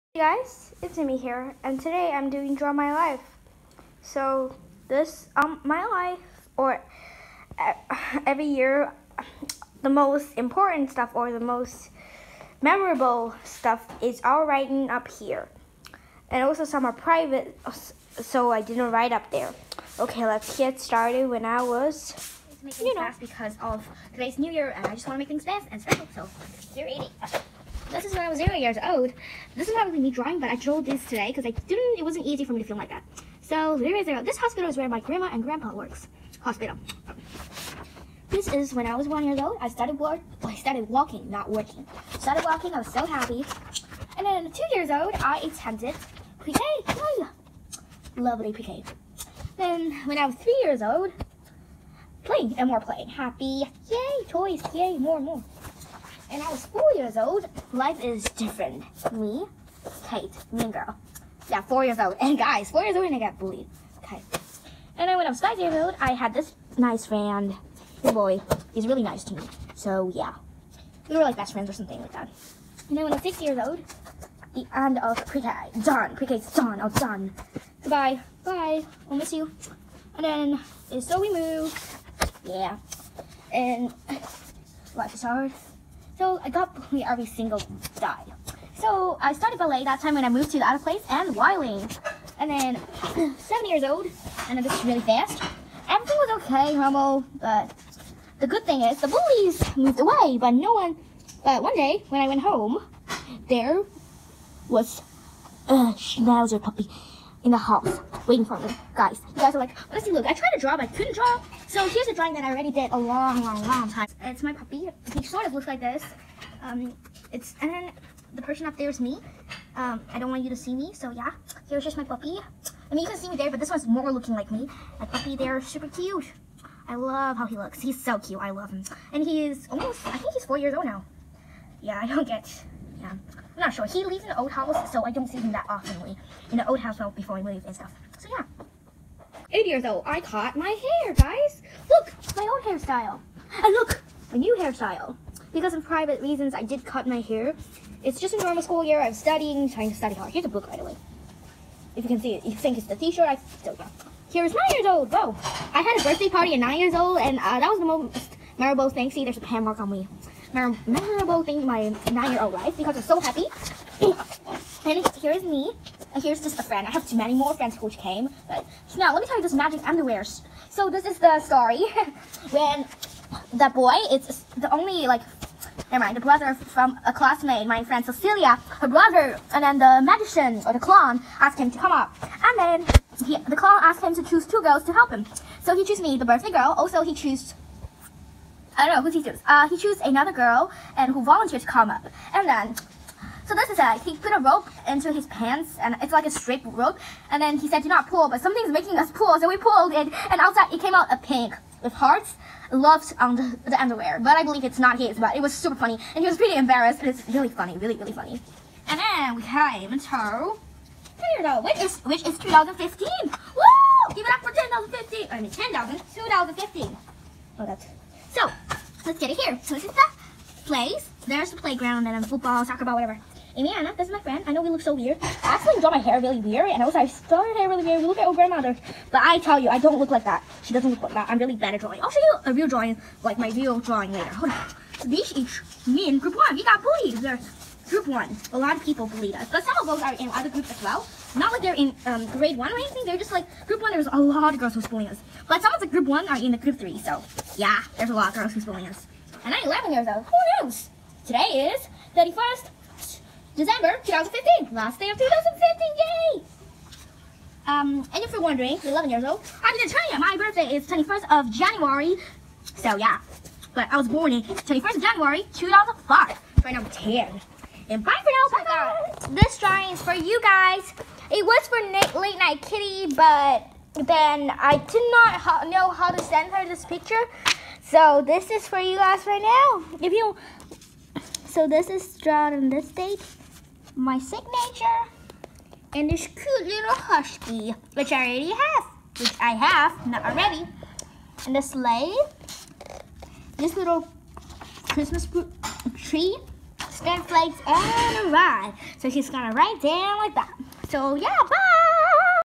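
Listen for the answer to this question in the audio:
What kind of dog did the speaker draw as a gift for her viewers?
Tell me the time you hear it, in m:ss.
4:46.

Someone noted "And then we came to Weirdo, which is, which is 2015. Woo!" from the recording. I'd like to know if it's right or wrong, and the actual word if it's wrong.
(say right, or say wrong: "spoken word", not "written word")
right.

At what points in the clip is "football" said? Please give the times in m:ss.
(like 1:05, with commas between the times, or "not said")
3:42.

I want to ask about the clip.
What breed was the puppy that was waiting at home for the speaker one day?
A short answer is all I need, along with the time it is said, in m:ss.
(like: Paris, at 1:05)
Schnauzer, at 1:45.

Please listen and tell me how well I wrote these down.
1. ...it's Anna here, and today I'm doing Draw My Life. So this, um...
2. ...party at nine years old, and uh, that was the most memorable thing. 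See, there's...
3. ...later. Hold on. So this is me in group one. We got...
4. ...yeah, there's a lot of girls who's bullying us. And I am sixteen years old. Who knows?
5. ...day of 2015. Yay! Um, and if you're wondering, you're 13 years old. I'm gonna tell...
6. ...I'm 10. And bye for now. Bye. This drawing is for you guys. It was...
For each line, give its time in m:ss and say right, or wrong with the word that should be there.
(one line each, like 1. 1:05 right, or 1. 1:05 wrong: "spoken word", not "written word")
1. 0:00 wrong: "Amy", not "Anna"
2. 2:36 right
3. 3:54 right
4. 4:07 wrong: "eleven", not "sixteen"
5. 4:14 wrong: "11", not "13"
6. 4:26 right.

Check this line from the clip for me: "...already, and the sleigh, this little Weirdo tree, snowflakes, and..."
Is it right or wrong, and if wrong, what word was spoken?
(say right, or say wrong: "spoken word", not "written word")
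wrong: "Christmas", not "Weirdo".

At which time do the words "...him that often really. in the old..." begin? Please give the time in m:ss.
2:15.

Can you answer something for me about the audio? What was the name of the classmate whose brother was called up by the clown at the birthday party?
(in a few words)
Cecilia.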